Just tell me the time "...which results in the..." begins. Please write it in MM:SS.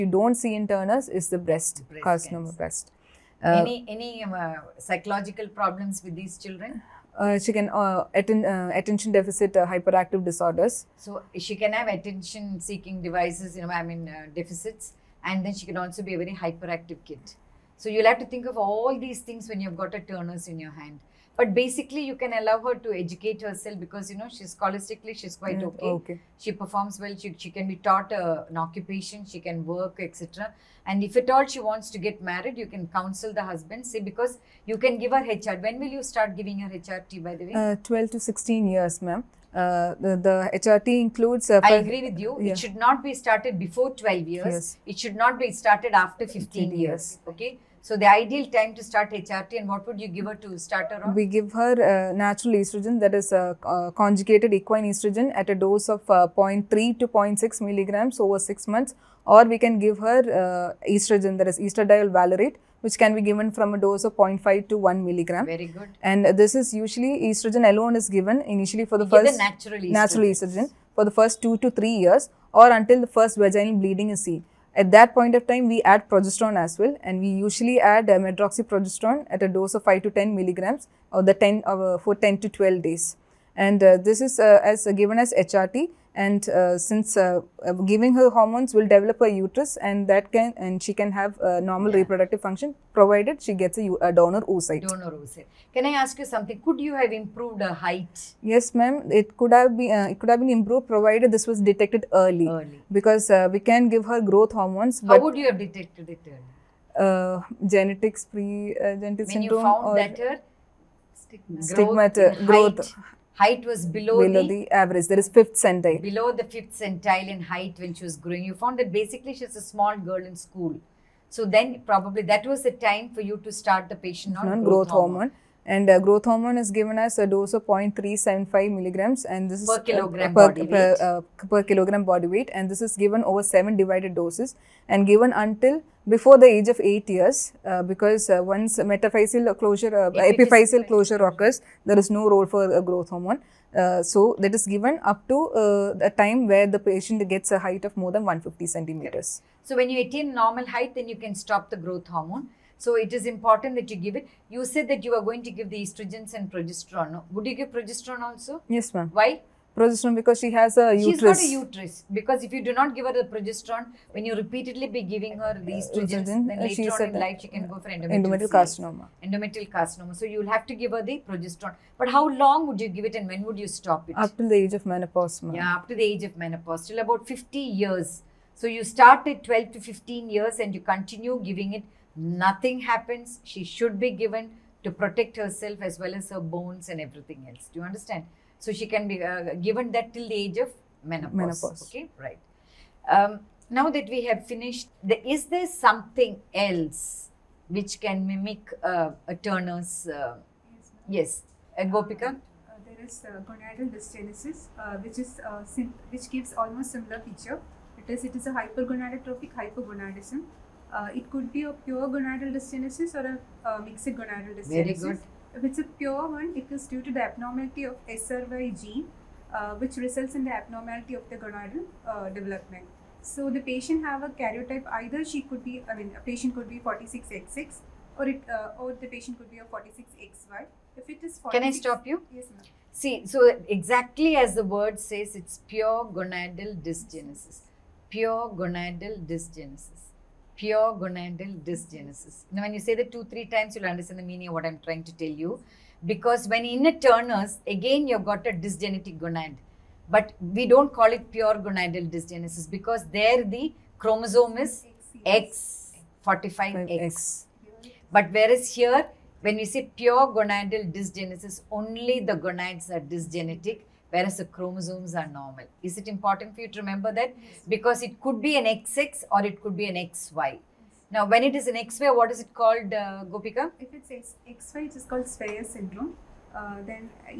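03:39.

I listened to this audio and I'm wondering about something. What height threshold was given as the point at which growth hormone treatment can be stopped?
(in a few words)
150 centimeters.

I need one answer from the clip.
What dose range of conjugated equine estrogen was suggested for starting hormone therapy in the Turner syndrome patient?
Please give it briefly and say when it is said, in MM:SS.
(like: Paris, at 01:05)
0.3 to 0.6 milligrams, at 00:56.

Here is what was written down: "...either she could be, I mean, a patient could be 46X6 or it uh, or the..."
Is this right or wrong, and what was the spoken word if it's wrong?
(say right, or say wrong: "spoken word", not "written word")
right.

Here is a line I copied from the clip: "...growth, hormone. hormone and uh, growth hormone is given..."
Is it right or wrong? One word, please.
right.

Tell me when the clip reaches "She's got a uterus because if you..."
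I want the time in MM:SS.
02:41.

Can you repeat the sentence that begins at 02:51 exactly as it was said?
But how long would you give it and when would you stop it?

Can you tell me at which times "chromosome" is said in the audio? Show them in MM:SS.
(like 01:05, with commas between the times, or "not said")
04:13, 04:24.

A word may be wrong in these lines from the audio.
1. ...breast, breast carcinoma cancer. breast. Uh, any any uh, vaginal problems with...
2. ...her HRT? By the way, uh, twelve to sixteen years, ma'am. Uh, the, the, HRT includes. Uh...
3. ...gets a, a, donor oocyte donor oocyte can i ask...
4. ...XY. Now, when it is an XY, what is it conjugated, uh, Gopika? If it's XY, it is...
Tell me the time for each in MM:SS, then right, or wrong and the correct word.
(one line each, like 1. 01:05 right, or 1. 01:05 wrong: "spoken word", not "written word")
1. 00:01 wrong: "psychological", not "vaginal"
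2. 00:36 right
3. 01:33 right
4. 04:29 wrong: "called", not "conjugated".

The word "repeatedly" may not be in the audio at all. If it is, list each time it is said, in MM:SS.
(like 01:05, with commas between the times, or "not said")
02:44.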